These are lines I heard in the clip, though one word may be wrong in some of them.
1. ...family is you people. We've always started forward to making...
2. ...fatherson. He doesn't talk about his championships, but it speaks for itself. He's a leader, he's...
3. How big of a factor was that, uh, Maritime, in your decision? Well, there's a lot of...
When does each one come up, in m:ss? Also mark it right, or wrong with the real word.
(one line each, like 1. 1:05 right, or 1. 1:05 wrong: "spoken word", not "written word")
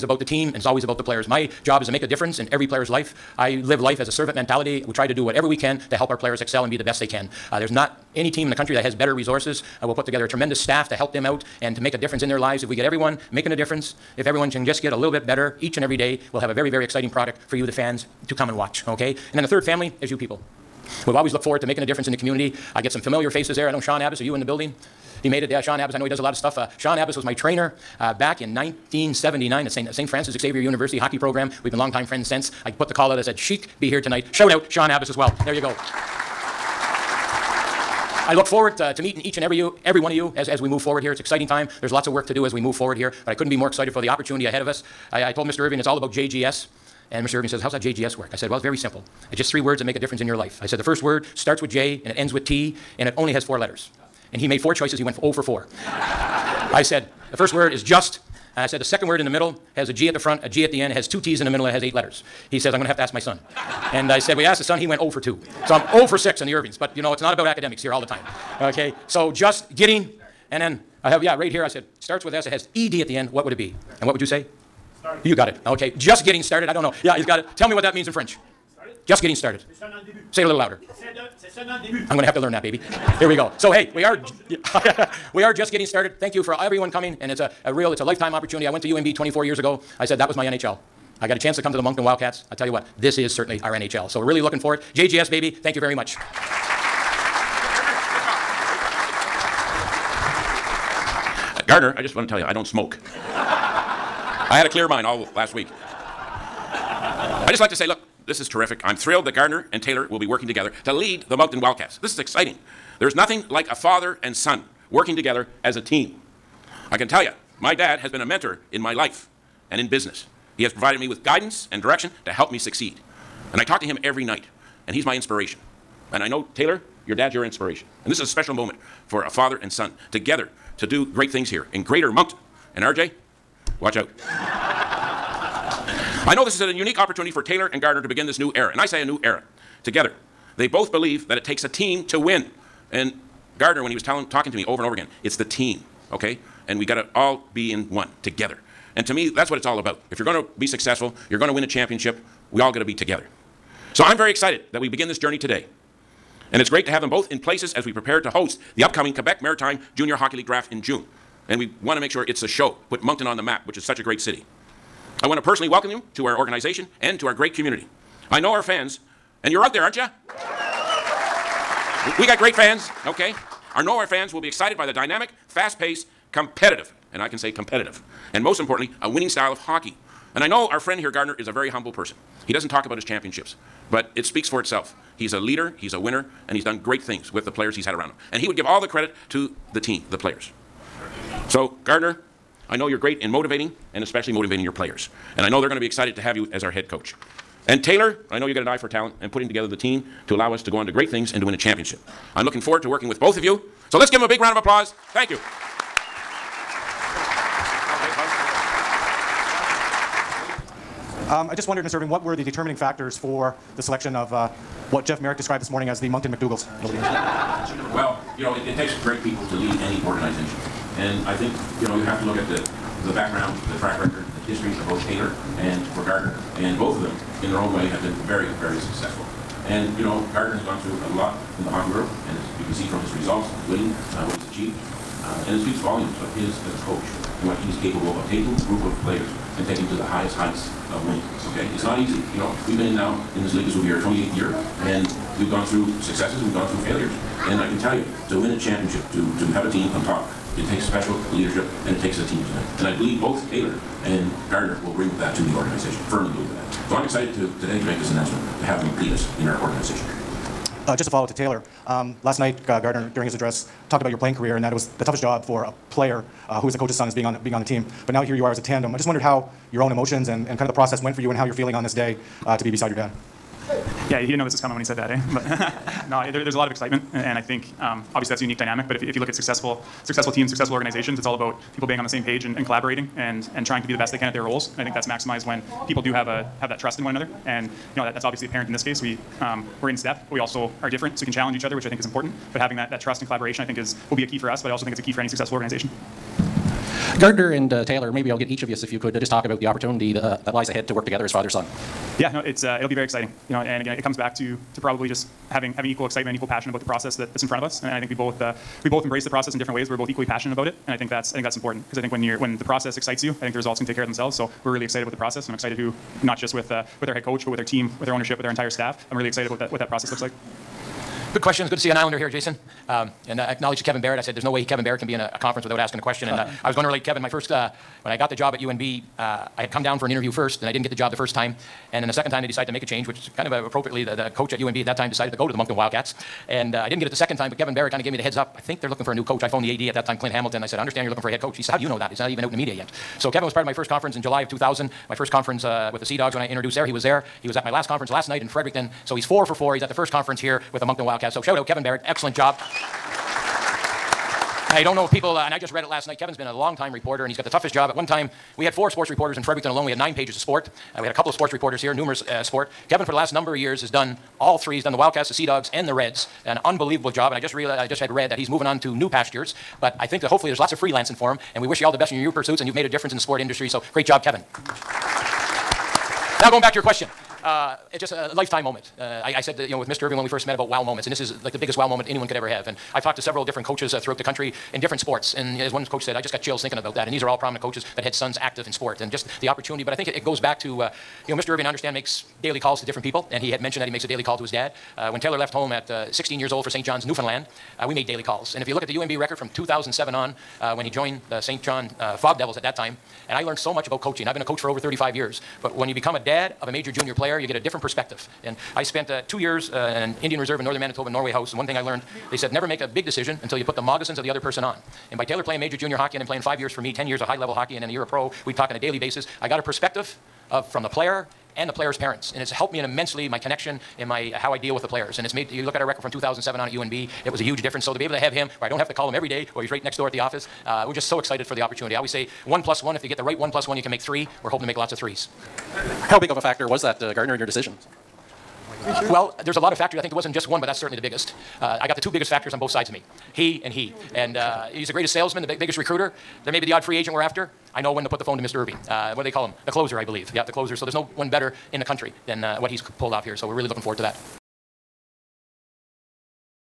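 1. 0:19 wrong: "looked", not "started"
2. 3:01 wrong: "person", not "fatherson"
3. 7:16 wrong: "Gardiner", not "Maritime".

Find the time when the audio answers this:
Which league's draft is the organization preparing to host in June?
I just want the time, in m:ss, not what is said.
2:39.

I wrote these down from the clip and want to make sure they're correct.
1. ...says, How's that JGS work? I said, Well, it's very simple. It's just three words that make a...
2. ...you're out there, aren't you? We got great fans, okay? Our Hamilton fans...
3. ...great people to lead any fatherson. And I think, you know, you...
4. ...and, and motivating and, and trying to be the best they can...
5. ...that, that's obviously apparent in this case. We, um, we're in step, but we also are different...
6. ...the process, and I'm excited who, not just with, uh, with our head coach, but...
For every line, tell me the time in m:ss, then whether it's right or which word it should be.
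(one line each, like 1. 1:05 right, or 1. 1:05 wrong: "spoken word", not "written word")
1. 0:47 right
2. 2:49 wrong: "Norway", not "Hamilton"
3. 3:39 wrong: "organization", not "fatherson"
4. 4:42 wrong: "collaborating", not "motivating"
5. 4:48 right
6. 5:15 right.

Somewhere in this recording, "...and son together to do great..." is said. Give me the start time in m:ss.
2:09.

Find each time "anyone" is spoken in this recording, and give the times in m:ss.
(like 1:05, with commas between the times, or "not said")
6:22.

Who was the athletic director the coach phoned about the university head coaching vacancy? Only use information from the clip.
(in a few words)
Clint Hamilton.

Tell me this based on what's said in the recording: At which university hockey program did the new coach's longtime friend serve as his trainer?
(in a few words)
St. Francis Xavier University.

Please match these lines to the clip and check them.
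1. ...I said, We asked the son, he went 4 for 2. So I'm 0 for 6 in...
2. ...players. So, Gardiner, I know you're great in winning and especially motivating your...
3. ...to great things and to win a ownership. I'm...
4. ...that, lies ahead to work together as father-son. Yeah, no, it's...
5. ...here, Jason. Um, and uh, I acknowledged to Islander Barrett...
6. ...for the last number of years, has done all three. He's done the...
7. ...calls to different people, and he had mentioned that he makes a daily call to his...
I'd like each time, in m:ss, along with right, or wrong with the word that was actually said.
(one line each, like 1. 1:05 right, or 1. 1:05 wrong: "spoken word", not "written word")
1. 1:04 wrong: "0", not "4"
2. 3:10 wrong: "motivating", not "winning"
3. 3:20 wrong: "championship", not "ownership"
4. 5:00 right
5. 5:22 wrong: "Kevin", not "Islander"
6. 6:03 right
7. 6:32 right.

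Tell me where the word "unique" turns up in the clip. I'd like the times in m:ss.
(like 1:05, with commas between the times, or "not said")
2:16, 4:38.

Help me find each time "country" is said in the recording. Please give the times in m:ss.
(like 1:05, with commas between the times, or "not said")
0:08, 6:24, 7:31.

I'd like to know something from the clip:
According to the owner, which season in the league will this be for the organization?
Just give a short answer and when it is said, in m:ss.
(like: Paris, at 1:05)
28th, at 4:04.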